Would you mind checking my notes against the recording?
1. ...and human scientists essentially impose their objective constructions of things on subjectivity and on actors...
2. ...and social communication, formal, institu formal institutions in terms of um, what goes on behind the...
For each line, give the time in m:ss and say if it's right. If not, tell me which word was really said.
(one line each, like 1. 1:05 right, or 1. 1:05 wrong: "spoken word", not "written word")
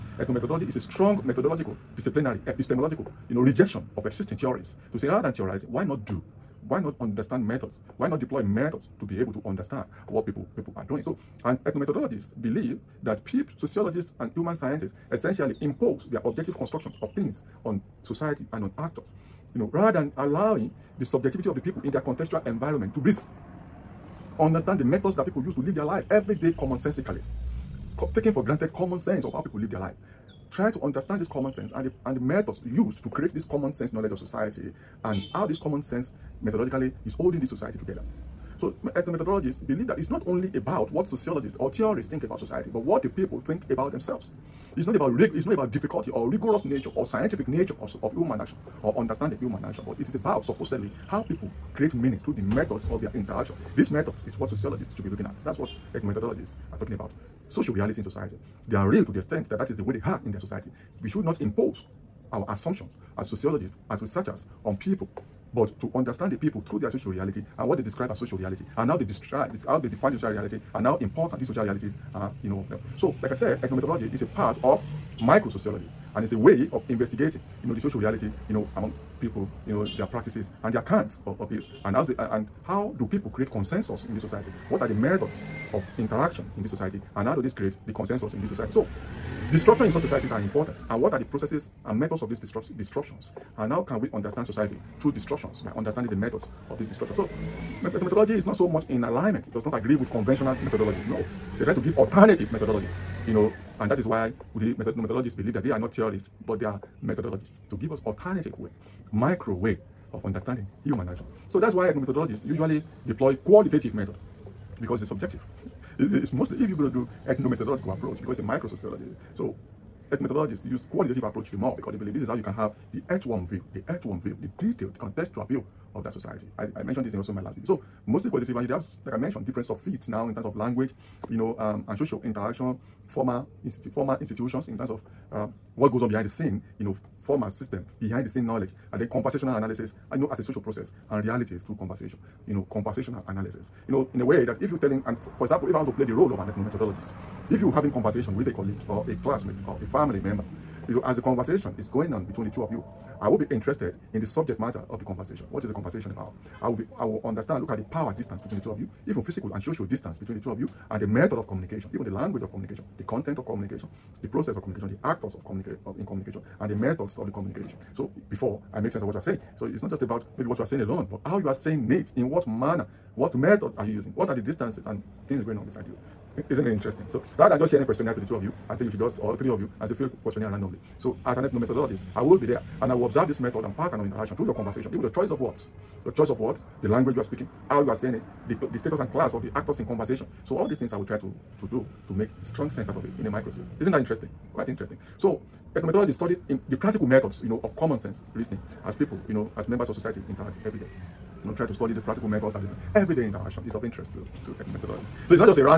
1. 0:14 wrong: "society", not "subjectivity"
2. 2:11 wrong: "interaction", not "communication".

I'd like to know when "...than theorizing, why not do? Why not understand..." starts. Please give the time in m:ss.
0:05.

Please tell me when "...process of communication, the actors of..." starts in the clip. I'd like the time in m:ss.
2:44.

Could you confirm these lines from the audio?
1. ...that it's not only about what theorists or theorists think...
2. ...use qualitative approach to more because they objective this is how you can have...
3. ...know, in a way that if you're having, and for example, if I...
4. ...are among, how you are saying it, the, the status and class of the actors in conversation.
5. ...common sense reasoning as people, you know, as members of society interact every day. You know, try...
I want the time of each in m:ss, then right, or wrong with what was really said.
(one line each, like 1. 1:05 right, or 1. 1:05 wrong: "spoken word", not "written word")
1. 0:39 wrong: "sociologists", not "theorists"
2. 2:00 wrong: "believe", not "objective"
3. 2:23 wrong: "telling", not "having"
4. 3:07 wrong: "speaking", not "among"
5. 3:17 right.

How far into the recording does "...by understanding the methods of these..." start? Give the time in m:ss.
1:35.